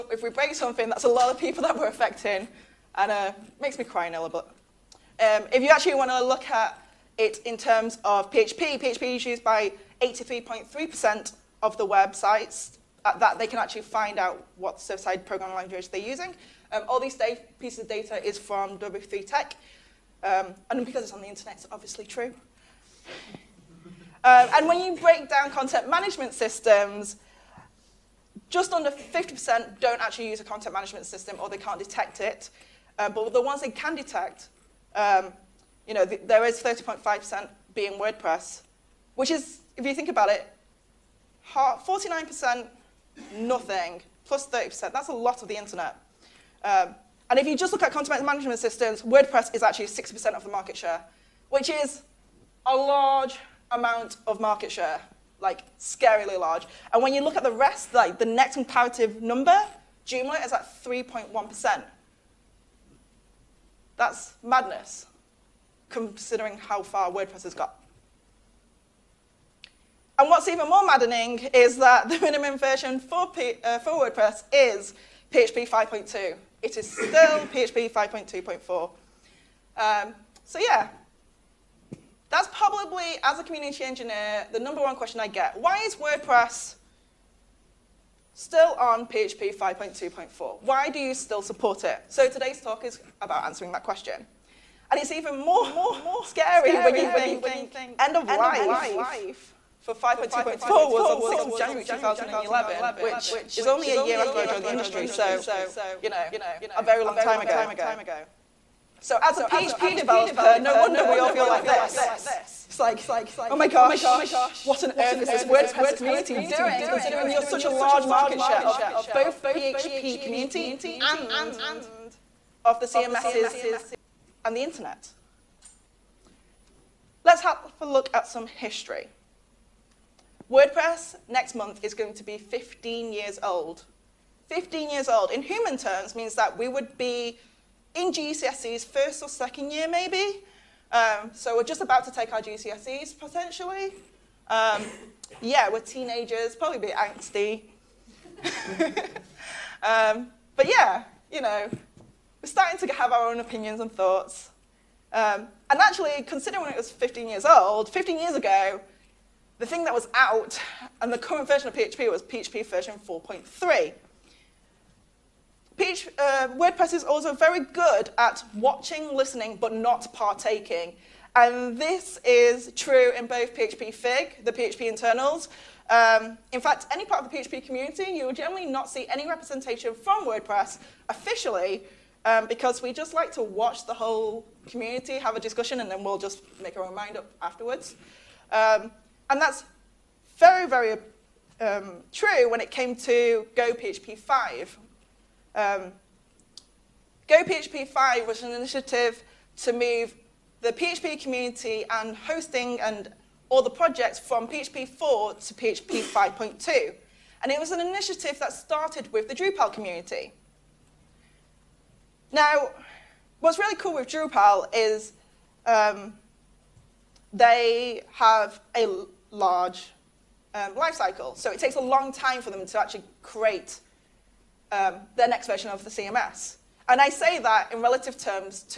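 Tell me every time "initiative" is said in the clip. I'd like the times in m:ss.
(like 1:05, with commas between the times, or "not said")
3:18, 3:27.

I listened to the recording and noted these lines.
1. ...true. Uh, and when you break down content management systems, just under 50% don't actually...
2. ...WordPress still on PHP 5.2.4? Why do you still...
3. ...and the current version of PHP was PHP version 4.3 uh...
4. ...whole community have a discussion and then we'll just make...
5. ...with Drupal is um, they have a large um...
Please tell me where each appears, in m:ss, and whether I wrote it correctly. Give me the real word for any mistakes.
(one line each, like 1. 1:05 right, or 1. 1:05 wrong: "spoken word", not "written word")
1. 0:22 right
2. 1:25 right
3. 2:40 right
4. 3:03 right
5. 3:33 right.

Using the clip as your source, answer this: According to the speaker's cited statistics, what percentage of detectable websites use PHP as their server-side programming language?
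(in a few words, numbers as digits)
83.3%.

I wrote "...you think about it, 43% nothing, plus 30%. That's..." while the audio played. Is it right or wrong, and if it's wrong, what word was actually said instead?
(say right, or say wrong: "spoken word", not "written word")
wrong: "49", not "43".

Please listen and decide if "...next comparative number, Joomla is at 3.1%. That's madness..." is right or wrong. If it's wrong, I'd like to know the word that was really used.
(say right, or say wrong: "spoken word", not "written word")
right.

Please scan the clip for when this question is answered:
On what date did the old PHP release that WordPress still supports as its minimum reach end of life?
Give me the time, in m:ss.
1:41.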